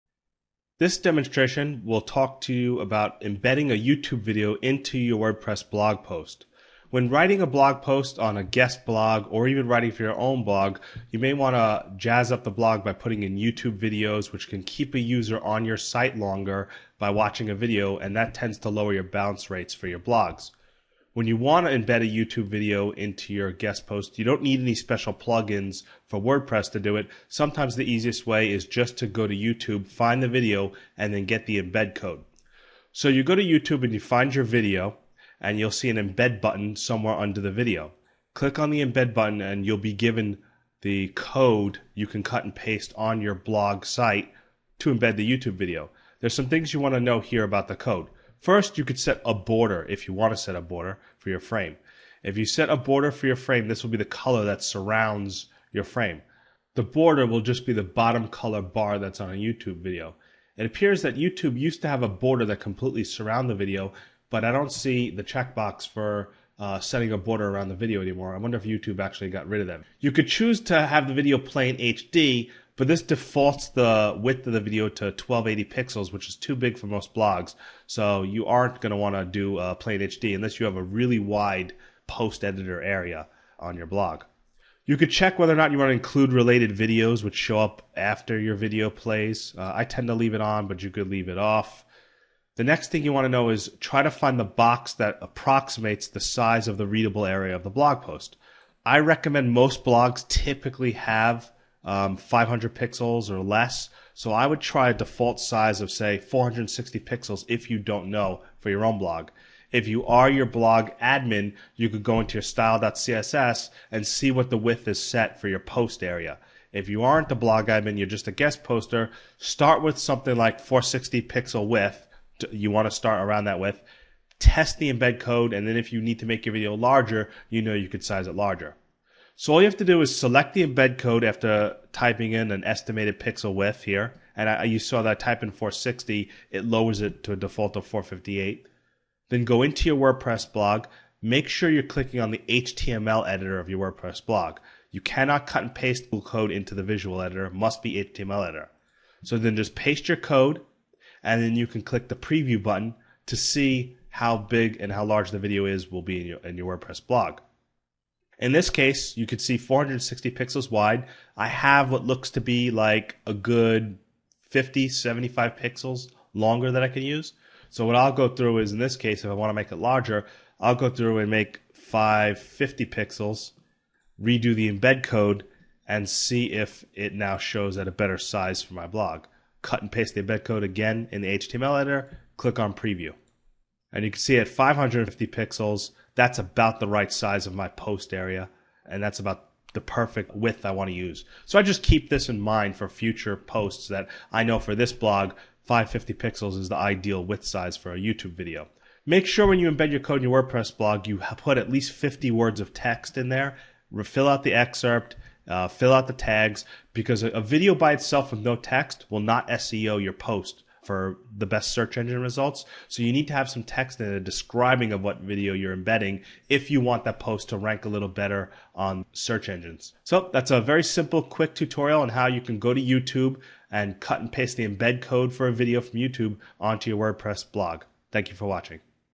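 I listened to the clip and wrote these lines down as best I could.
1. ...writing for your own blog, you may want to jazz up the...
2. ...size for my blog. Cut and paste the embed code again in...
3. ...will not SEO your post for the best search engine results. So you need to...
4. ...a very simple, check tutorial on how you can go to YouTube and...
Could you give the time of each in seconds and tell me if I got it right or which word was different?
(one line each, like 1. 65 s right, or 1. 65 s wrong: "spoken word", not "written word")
1. 9 s right
2. 178 s right
3. 209 s right
4. 220 s wrong: "quick", not "check".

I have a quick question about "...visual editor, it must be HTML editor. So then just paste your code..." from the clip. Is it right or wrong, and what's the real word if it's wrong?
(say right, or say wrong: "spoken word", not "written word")
right.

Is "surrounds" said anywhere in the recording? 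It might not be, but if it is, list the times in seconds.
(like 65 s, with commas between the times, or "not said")
54 s, 63 s.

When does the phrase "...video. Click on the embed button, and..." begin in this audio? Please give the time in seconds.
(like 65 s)
37 s.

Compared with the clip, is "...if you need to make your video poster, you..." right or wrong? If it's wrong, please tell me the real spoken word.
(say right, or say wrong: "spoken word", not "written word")
wrong: "larger", not "poster".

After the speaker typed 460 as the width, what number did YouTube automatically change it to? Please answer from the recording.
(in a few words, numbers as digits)
458.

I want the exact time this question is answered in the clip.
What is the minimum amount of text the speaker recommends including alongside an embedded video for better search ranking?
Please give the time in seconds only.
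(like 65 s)
201 s.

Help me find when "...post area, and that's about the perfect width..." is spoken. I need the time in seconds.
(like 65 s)
187 s.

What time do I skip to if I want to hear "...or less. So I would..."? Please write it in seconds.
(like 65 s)
103 s.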